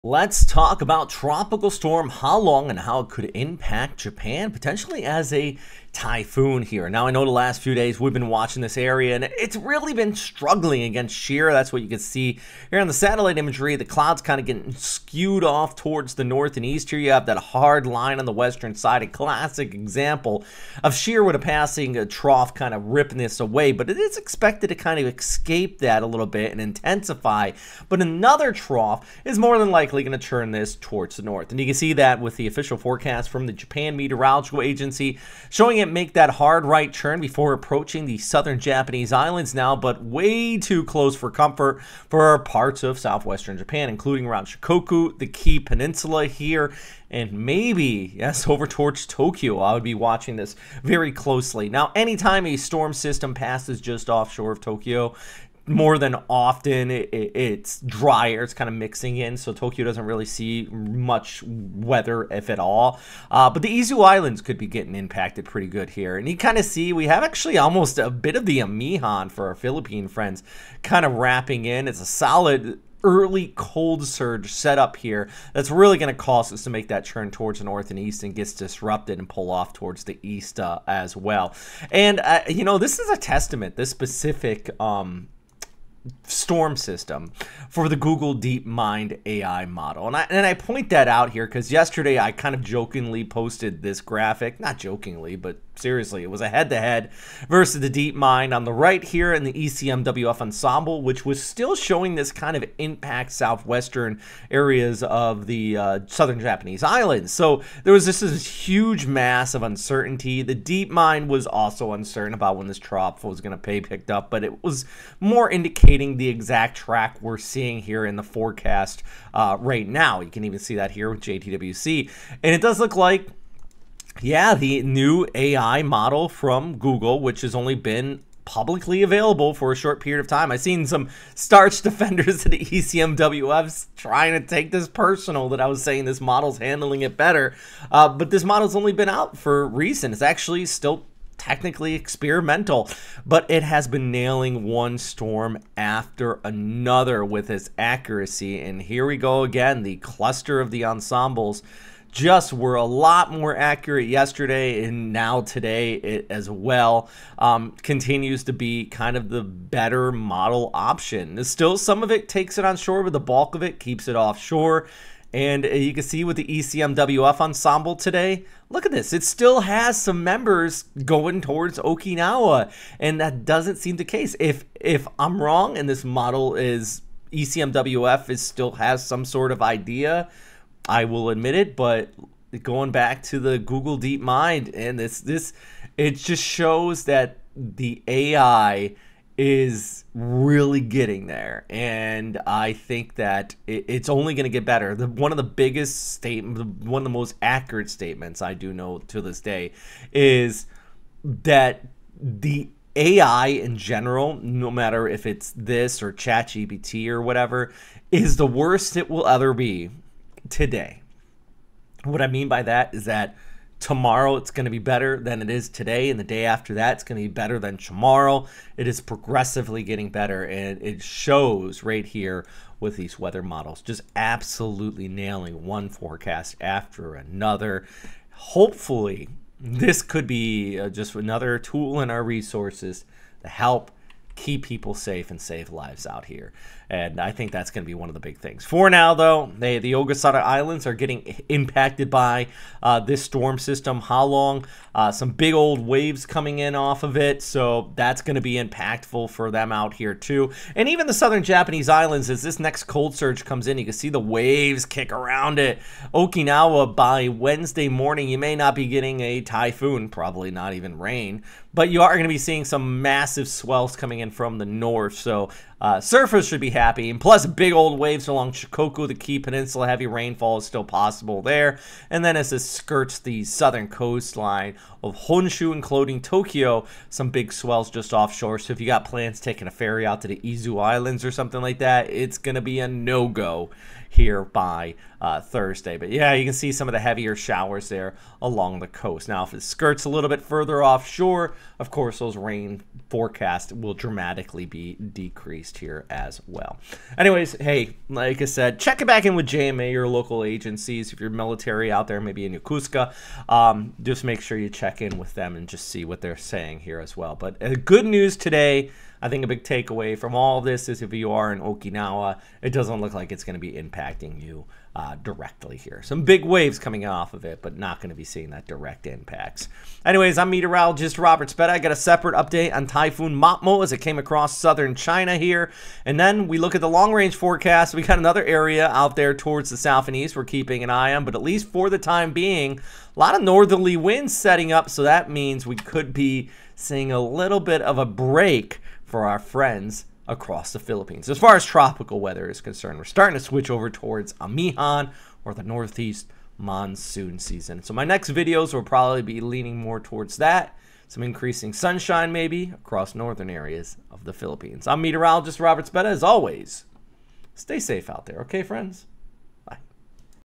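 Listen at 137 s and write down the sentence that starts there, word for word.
Uh, but this model's only been out for recent.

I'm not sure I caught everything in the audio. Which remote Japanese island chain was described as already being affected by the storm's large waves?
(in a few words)
Ogasawara Islands.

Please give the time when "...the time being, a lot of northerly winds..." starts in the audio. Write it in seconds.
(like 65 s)
331 s.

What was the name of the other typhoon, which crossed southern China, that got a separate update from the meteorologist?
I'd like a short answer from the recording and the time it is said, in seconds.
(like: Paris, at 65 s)
Typhoon Matmo, at 322 s.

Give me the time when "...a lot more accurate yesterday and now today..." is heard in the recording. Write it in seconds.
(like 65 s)
152 s.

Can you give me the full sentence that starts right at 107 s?
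So there was this, this huge mass of uncertainty.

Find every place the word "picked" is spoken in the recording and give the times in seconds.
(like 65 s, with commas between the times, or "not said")
113 s.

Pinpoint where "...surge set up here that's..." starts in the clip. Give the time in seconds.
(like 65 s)
74 s.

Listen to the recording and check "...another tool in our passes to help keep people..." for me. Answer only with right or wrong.
wrong.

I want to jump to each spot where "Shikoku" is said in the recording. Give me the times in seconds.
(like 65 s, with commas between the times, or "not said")
44 s, 268 s.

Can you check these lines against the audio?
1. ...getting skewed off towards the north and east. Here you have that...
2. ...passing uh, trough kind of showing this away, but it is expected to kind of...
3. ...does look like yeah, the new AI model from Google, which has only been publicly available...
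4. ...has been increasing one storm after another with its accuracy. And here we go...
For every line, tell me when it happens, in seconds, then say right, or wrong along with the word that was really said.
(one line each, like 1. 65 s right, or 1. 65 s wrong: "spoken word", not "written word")
1. 14 s right
2. 21 s wrong: "ripping", not "showing"
3. 122 s right
4. 143 s wrong: "nailing", not "increasing".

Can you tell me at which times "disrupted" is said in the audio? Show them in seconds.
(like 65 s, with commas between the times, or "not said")
78 s.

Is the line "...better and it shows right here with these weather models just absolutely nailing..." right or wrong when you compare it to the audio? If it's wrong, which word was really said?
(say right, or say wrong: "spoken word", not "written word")
right.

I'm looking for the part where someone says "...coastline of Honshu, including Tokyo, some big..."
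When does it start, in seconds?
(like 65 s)
273 s.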